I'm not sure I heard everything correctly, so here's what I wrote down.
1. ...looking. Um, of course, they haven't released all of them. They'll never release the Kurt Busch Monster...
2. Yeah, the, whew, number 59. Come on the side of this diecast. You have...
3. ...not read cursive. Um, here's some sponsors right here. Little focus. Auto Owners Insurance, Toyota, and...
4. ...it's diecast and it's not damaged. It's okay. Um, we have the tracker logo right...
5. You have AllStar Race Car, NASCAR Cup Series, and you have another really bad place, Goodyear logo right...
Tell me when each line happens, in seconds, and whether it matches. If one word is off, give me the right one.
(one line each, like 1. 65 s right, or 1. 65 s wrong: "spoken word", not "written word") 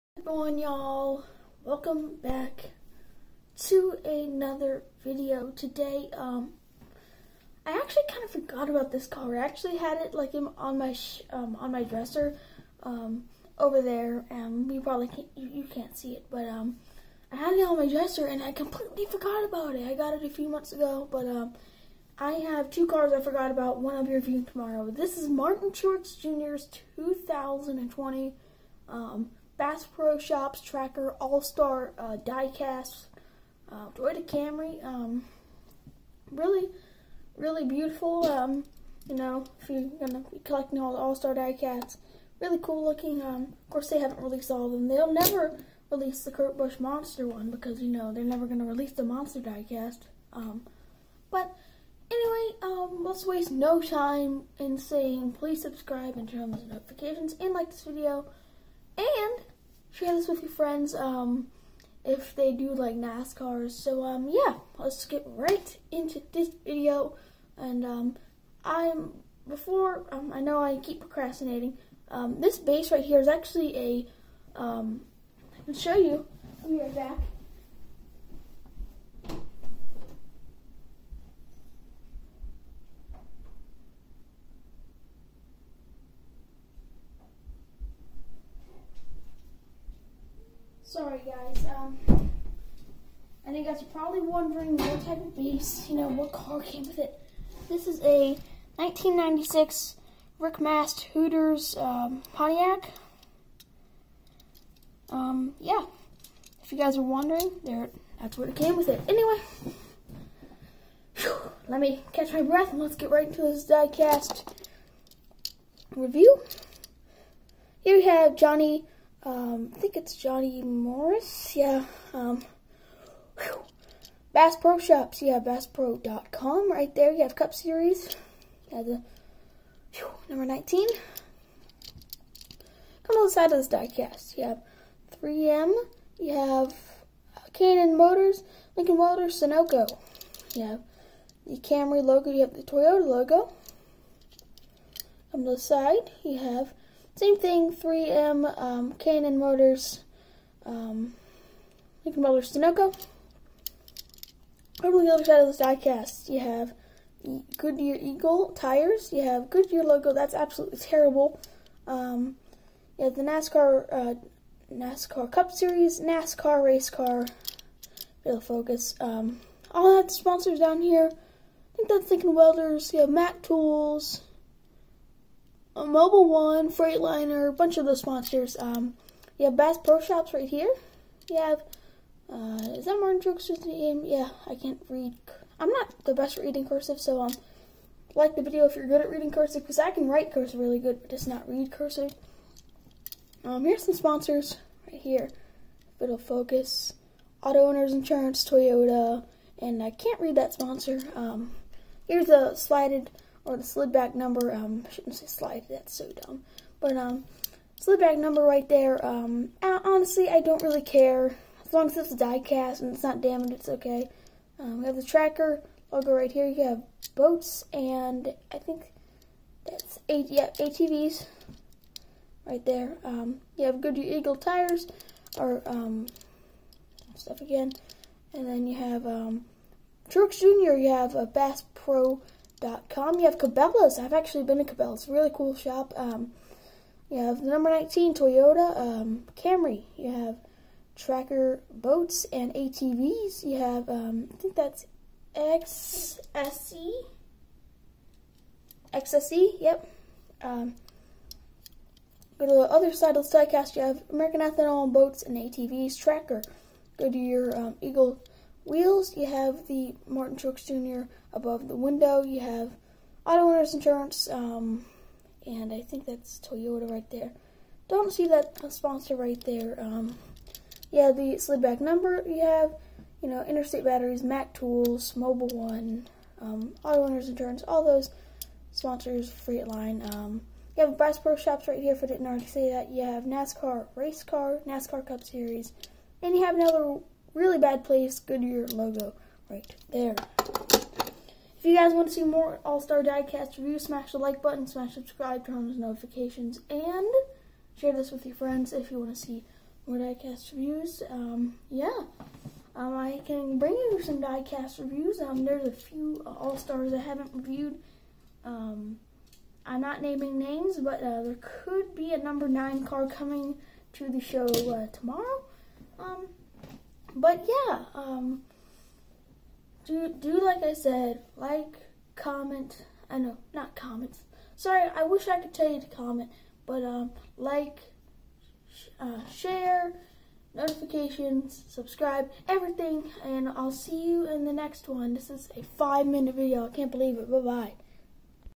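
1. 42 s right
2. 128 s wrong: "19", not "59"
3. 191 s right
4. 211 s right
5. 282 s wrong: "NASCAR", not "AllStar".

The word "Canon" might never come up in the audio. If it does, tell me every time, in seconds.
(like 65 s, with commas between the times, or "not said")
137 s, 148 s.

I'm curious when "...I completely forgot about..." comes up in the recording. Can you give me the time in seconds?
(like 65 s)
18 s.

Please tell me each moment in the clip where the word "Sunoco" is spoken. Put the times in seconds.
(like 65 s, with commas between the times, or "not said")
139 s, 152 s.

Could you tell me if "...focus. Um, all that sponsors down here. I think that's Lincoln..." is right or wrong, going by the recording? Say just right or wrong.
right.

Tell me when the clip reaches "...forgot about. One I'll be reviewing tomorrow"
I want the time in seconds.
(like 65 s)
23 s.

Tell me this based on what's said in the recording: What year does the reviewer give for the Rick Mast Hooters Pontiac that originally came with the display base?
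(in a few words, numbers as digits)
1996.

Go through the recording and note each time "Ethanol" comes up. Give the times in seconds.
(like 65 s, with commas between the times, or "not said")
254 s.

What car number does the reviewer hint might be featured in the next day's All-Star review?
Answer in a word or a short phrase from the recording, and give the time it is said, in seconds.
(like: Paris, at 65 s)
9, at 312 s.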